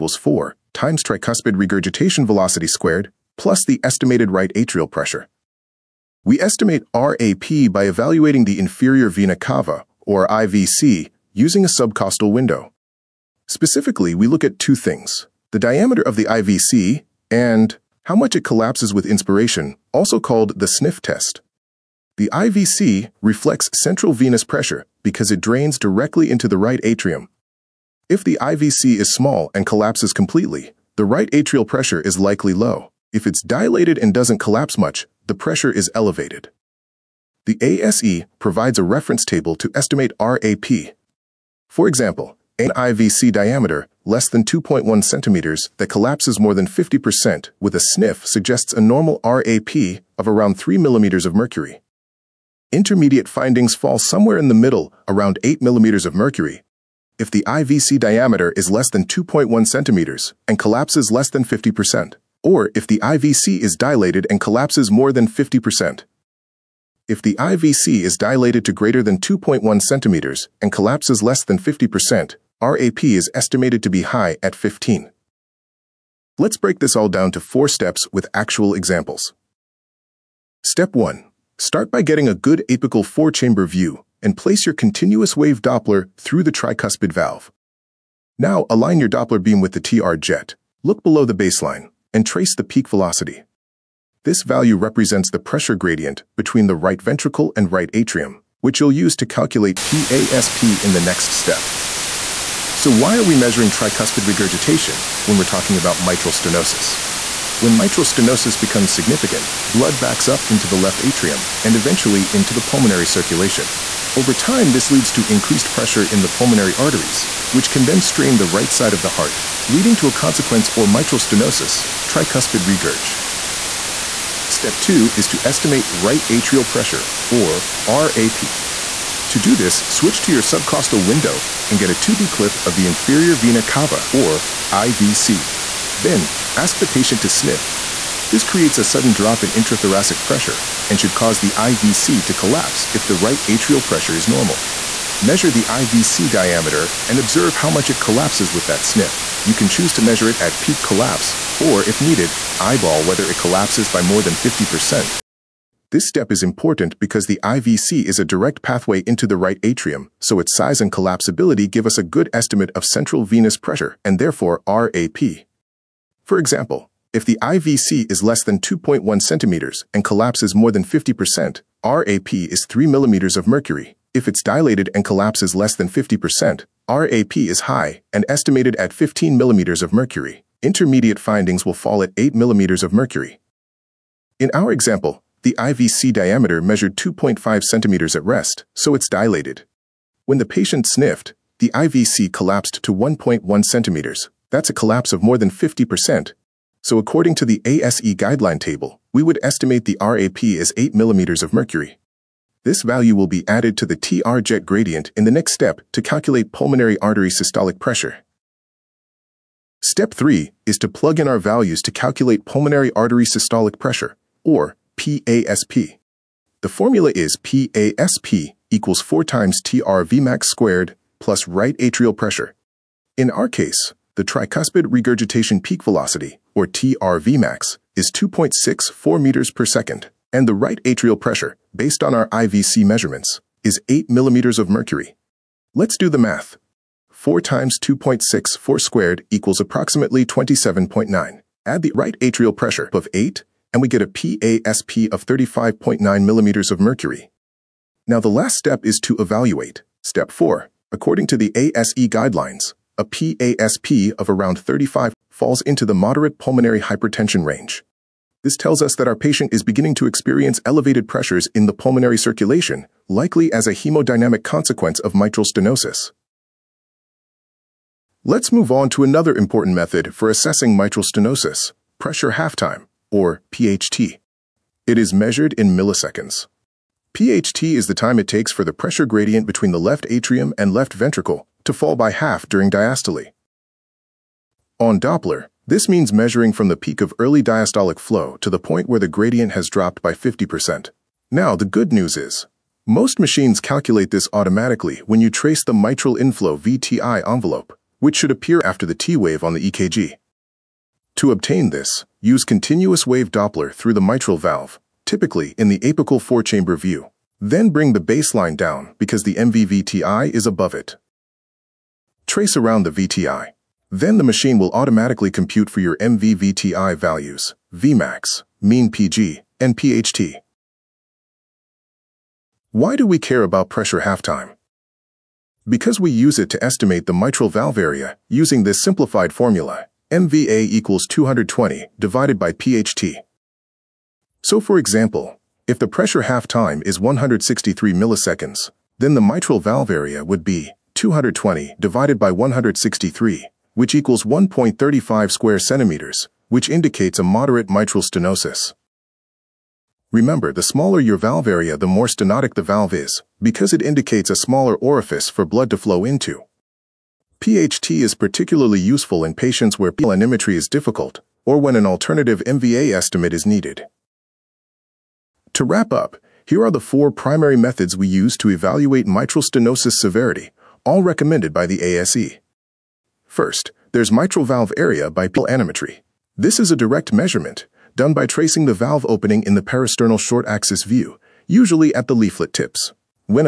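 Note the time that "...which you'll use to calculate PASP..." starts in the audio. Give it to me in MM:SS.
01:38.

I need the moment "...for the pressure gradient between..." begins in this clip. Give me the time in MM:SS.
04:38.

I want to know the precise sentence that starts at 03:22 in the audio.
This value will be added to the TR jet gradient in the next step to calculate pulmonary artery systolic pressure.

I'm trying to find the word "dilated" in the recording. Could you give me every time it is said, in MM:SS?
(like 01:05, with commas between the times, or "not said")
00:33, 01:03, 01:08, 02:54, 03:09.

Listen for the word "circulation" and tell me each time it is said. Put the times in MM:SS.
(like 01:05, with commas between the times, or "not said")
01:53, 04:22.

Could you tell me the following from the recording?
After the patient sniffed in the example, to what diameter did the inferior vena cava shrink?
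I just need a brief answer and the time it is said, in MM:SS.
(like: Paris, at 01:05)
1.1 cm, at 03:12.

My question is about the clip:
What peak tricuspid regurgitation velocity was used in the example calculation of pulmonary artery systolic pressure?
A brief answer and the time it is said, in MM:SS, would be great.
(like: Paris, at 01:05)
2.64 m/s, at 03:48.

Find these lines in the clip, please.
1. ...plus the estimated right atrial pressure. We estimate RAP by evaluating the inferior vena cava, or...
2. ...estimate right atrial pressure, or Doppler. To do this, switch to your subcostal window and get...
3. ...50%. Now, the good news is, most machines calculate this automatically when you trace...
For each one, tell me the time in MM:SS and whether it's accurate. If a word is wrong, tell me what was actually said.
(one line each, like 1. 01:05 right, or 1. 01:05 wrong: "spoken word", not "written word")
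1. 00:03 right
2. 02:05 wrong: "RAP", not "Doppler"
3. 04:50 right.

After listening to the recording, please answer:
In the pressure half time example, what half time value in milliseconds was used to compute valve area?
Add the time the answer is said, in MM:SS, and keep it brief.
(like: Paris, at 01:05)
163 ms, at 05:36.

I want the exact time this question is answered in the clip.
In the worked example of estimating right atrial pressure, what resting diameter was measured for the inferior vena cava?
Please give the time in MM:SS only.
03:06.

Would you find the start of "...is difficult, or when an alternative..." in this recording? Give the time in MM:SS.
06:00.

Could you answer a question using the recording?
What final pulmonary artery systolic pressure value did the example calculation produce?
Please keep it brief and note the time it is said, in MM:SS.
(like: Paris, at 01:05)
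35.9 mmHg, at 04:05.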